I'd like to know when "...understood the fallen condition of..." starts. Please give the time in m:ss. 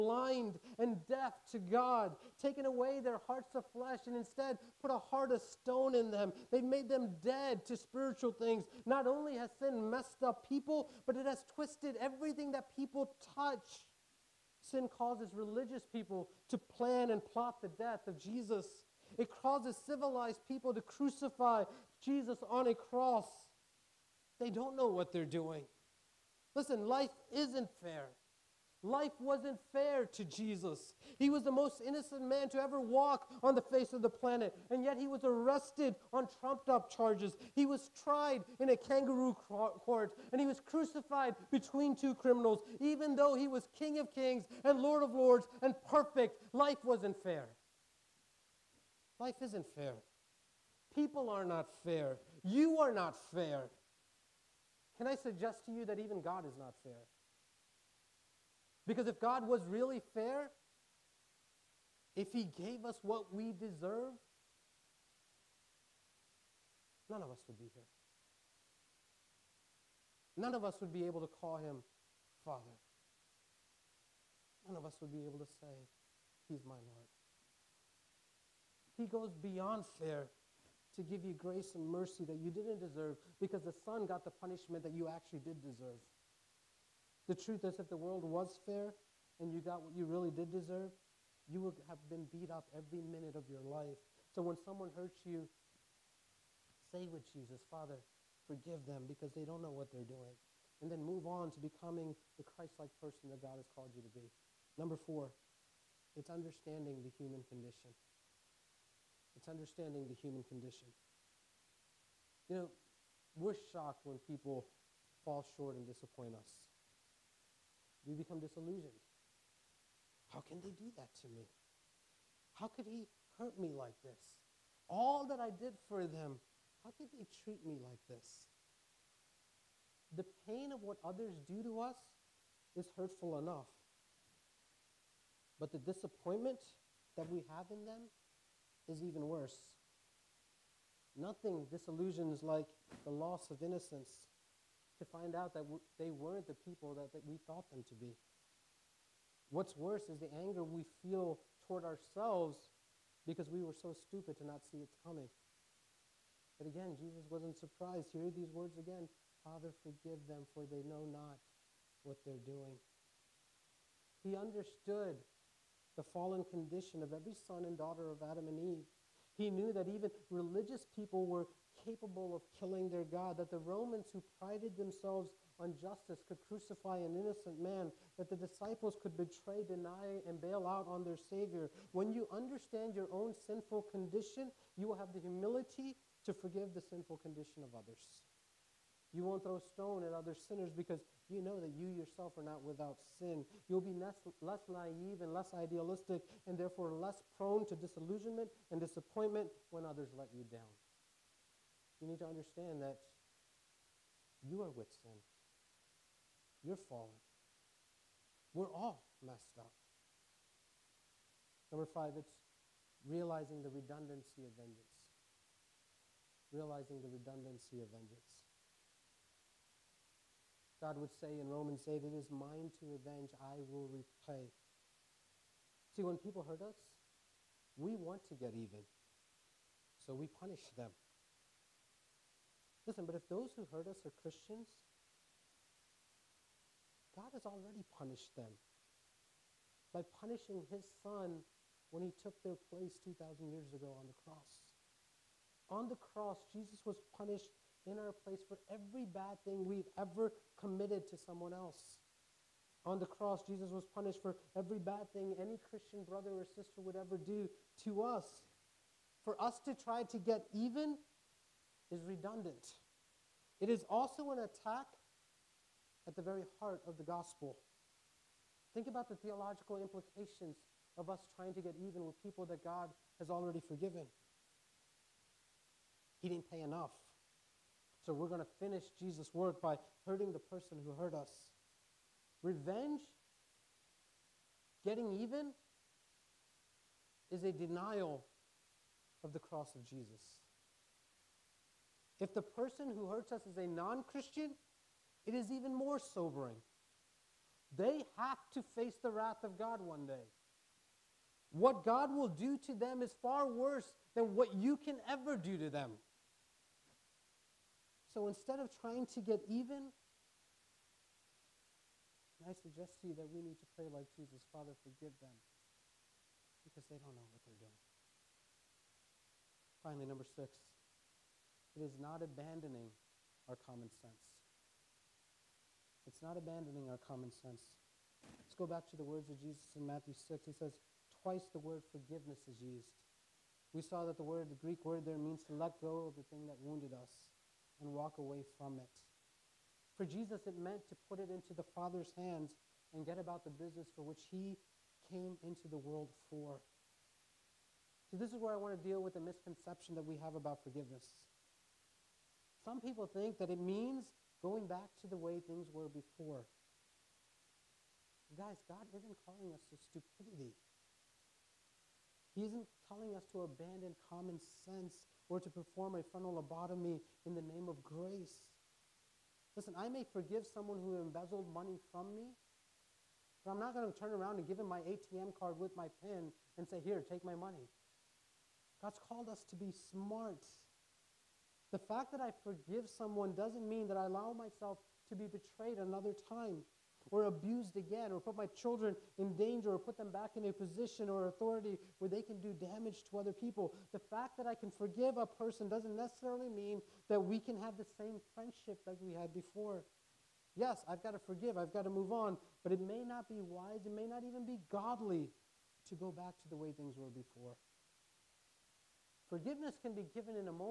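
2:44.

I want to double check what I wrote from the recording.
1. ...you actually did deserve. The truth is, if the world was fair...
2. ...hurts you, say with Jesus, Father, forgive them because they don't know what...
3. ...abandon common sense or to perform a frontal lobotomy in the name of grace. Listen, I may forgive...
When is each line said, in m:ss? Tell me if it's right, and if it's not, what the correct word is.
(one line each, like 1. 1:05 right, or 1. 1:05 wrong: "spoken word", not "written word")
1. 1:24 right
2. 1:34 right
3. 6:03 right.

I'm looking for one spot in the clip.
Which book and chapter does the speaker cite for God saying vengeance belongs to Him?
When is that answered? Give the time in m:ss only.
3:41.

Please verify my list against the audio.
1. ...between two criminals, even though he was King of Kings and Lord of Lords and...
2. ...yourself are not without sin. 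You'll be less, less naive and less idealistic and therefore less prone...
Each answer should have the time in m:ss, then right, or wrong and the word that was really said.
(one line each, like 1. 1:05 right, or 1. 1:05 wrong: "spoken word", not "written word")
1. 0:41 right
2. 3:11 right.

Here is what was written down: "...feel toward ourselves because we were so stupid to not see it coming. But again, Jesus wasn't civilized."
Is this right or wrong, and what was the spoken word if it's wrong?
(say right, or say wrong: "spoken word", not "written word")
wrong: "surprised", not "civilized".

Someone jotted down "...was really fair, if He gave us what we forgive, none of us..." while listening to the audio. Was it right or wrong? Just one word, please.
wrong.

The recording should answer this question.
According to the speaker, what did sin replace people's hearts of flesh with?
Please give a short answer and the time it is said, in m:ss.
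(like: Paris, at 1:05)
a heart of stone, at 0:04.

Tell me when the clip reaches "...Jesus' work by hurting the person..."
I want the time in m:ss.
4:38.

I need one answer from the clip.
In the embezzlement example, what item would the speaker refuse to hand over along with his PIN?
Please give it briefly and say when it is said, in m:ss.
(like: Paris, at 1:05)
ATM card, at 6:14.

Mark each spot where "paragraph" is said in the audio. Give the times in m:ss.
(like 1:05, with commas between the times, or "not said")
not said.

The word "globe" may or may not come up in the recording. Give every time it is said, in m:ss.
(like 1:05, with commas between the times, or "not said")
not said.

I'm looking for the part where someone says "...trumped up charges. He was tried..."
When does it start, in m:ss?
0:36.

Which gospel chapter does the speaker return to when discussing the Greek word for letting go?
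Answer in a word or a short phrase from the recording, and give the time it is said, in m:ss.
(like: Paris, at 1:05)
Matthew 6, at 5:29.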